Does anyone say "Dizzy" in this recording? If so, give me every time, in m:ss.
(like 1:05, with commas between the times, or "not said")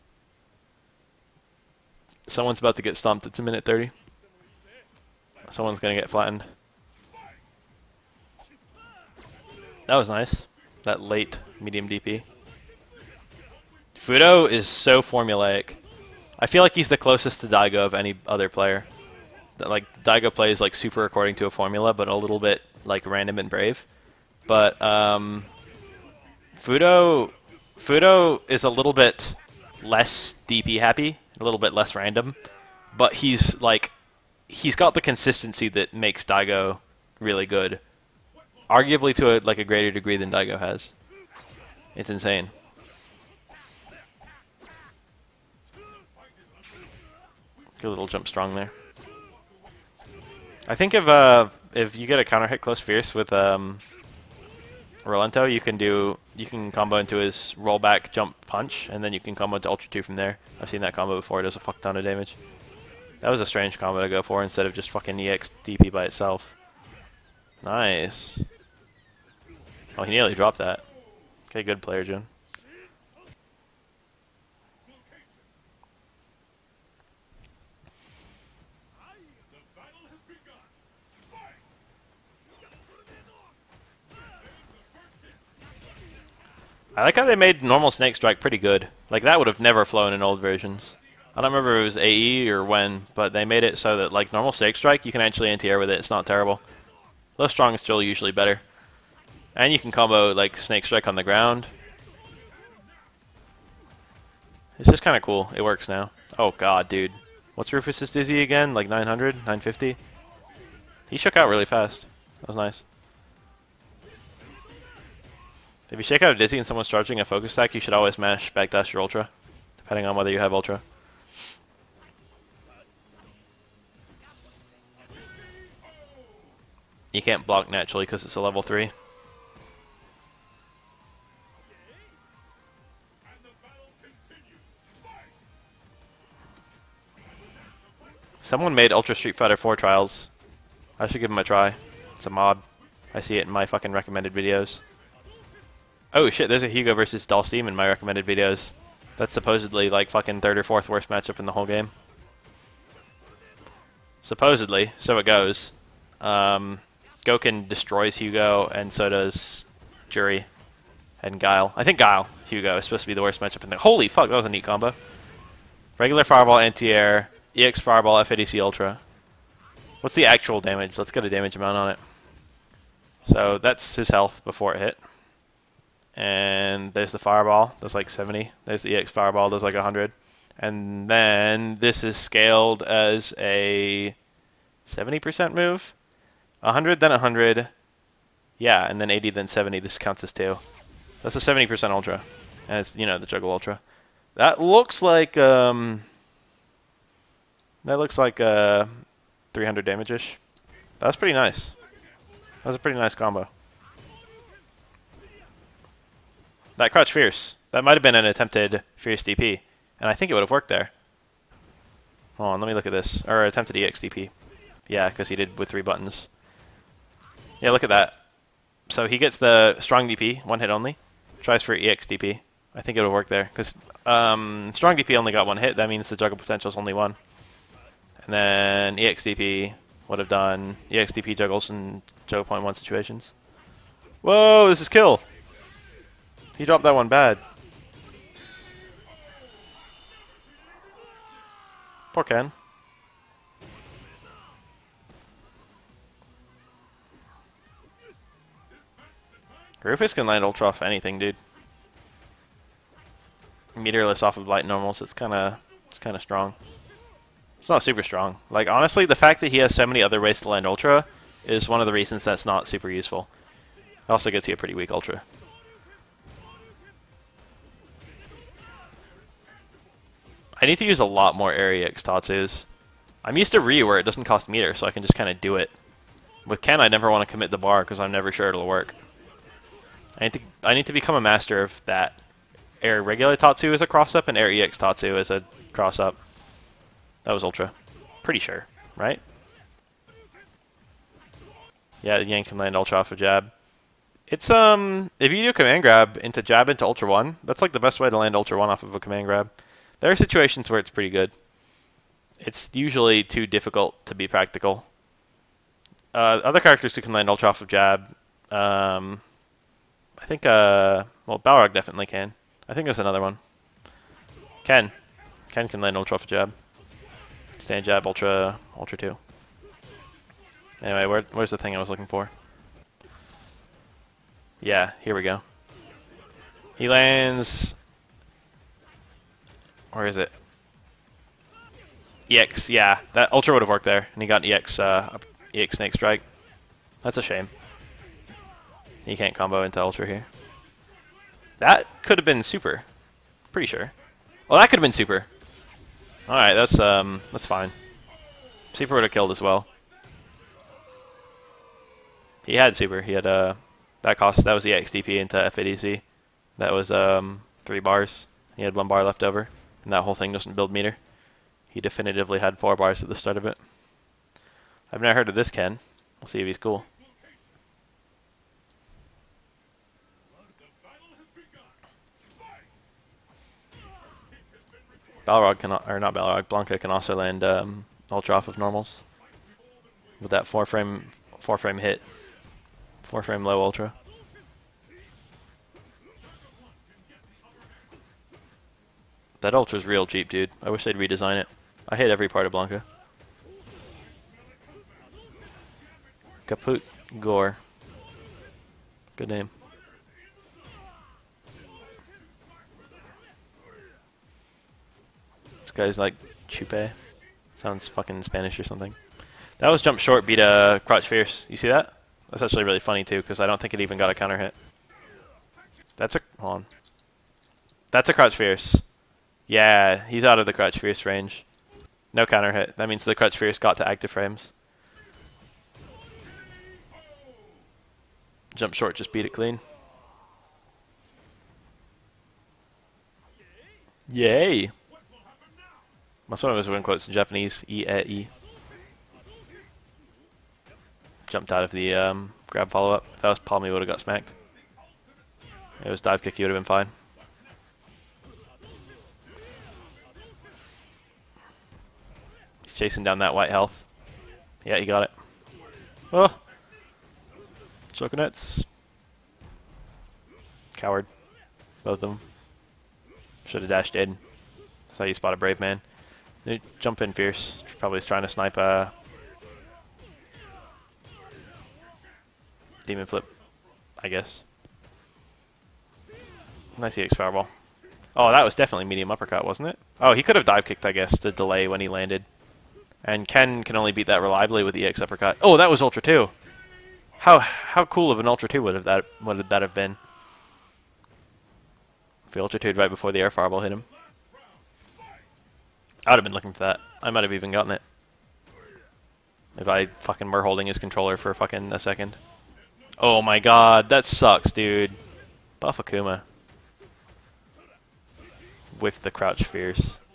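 1:48, 1:56.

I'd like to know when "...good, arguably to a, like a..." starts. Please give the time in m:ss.
0:37.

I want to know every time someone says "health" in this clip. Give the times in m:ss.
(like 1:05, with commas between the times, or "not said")
2:54, 7:33.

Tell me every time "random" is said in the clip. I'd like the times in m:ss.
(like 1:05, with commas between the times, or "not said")
0:23, 0:31.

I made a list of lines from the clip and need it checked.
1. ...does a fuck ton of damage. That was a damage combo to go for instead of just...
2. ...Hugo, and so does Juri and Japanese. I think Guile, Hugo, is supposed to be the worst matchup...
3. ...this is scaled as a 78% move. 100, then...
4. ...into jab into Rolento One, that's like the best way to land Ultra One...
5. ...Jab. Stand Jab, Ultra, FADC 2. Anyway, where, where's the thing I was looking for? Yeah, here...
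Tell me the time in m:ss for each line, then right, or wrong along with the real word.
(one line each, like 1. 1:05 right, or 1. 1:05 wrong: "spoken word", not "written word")
1. 1:01 wrong: "strange", not "damage"
2. 2:38 wrong: "Guile", not "Japanese"
3. 3:01 wrong: "70", not "78"
4. 4:56 wrong: "Ultra", not "Rolento"
5. 5:16 wrong: "Ultra", not "FADC".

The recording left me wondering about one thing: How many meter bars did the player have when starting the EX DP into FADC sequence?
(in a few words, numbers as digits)
4.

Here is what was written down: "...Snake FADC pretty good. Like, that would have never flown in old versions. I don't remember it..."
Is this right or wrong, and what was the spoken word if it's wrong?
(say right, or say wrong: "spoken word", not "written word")
wrong: "Strike", not "FADC".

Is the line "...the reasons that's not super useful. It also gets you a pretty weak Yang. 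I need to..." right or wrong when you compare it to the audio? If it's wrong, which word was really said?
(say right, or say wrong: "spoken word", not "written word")
wrong: "Ultra", not "Yang".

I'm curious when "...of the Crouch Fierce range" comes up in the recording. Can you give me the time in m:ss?
7:00.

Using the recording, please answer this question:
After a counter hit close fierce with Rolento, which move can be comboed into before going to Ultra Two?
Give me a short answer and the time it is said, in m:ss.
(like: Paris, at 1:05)
rollback jump punch, at 0:57.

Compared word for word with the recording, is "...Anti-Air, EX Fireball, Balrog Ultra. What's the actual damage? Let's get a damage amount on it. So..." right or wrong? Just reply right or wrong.
wrong.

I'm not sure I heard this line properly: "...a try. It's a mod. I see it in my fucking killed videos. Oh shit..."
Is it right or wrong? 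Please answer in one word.
wrong.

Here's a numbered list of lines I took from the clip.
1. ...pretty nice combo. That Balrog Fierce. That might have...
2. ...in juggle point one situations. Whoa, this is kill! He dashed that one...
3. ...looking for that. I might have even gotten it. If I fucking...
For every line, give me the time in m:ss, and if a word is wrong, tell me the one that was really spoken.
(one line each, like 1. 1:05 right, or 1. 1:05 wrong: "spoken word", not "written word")
1. 3:22 wrong: "Crouch", not "Balrog"
2. 3:51 wrong: "dropped", not "dashed"
3. 8:16 right.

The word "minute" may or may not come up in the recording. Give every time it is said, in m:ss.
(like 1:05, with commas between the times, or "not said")
0:03.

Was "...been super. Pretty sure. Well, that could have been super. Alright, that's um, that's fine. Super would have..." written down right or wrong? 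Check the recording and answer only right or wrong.
right.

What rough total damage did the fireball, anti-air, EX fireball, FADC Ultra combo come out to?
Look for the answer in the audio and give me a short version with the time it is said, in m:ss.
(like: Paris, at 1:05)
300, at 3:19.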